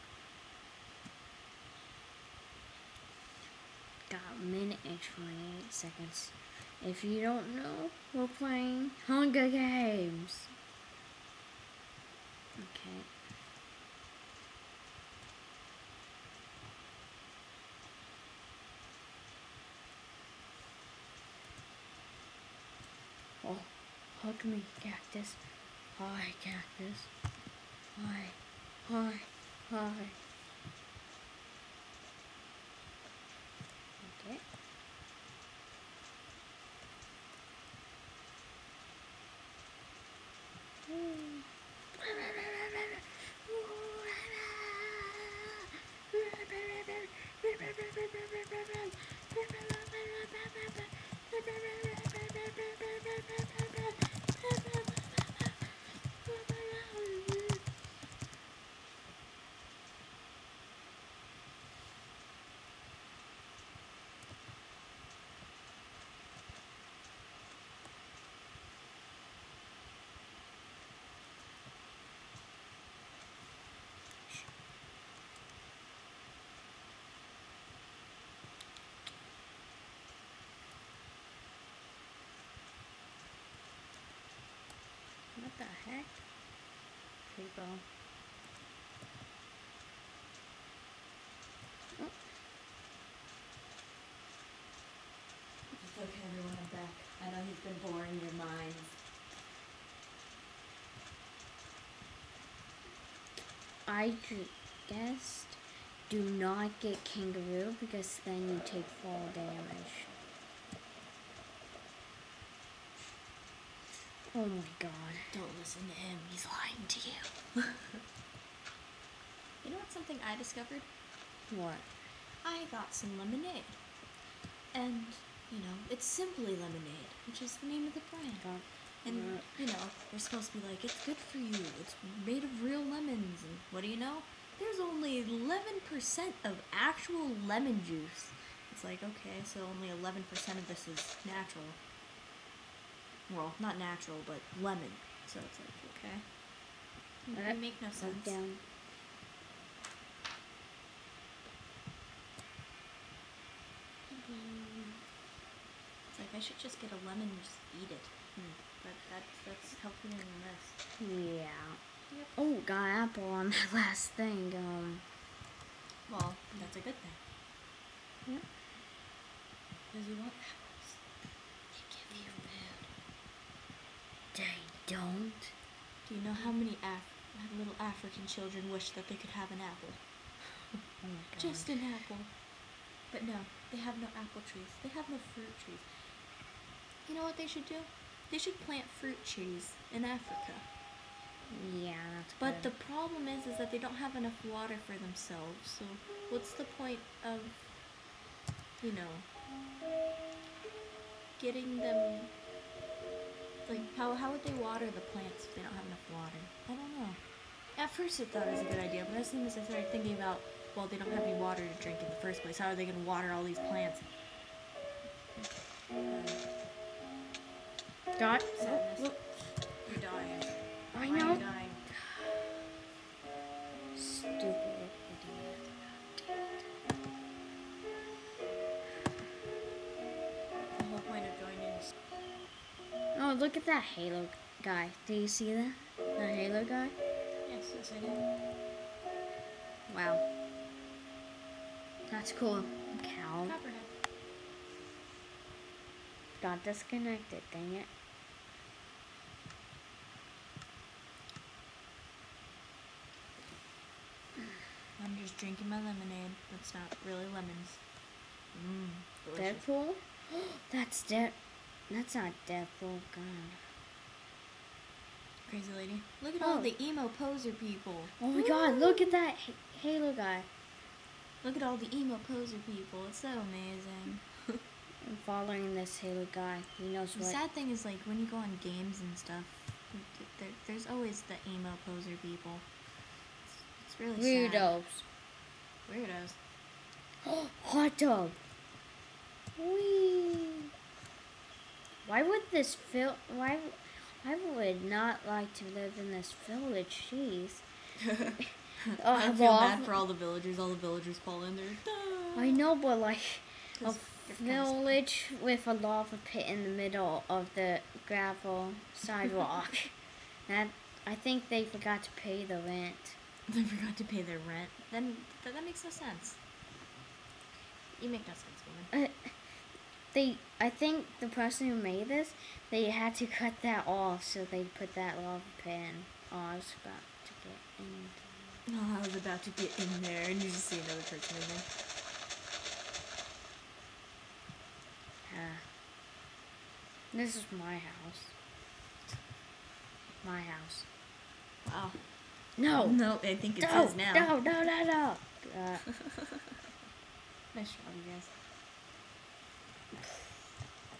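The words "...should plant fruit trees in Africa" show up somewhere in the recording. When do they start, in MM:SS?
03:08.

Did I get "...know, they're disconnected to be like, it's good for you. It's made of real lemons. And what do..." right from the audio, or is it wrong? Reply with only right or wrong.
wrong.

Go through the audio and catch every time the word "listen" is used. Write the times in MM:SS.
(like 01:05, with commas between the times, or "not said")
01:55.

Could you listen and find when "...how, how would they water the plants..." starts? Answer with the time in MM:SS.
03:23.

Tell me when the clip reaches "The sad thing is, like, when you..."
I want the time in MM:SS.
04:37.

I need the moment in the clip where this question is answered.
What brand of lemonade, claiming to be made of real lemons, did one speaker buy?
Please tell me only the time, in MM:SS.
02:06.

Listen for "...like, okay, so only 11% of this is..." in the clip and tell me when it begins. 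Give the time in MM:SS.
02:18.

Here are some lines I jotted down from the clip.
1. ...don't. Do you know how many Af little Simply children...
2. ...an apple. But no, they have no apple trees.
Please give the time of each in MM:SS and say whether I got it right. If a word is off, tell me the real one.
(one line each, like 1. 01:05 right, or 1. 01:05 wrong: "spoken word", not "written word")
1. 02:54 wrong: "African", not "Simply"
2. 03:01 right.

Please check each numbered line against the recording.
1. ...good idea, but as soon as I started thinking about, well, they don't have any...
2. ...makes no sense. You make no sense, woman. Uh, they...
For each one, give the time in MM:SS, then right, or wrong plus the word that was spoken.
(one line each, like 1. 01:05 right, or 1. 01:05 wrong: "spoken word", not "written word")
1. 03:28 right
2. 05:15 right.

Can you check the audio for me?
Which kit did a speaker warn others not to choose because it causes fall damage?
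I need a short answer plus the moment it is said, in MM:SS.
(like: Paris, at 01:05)
kangaroo, at 01:47.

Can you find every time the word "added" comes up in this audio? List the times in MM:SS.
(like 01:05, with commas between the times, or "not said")
not said.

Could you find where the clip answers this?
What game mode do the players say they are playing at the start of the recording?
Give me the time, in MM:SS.
00:09.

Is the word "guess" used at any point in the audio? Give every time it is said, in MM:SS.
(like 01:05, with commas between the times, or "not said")
01:44.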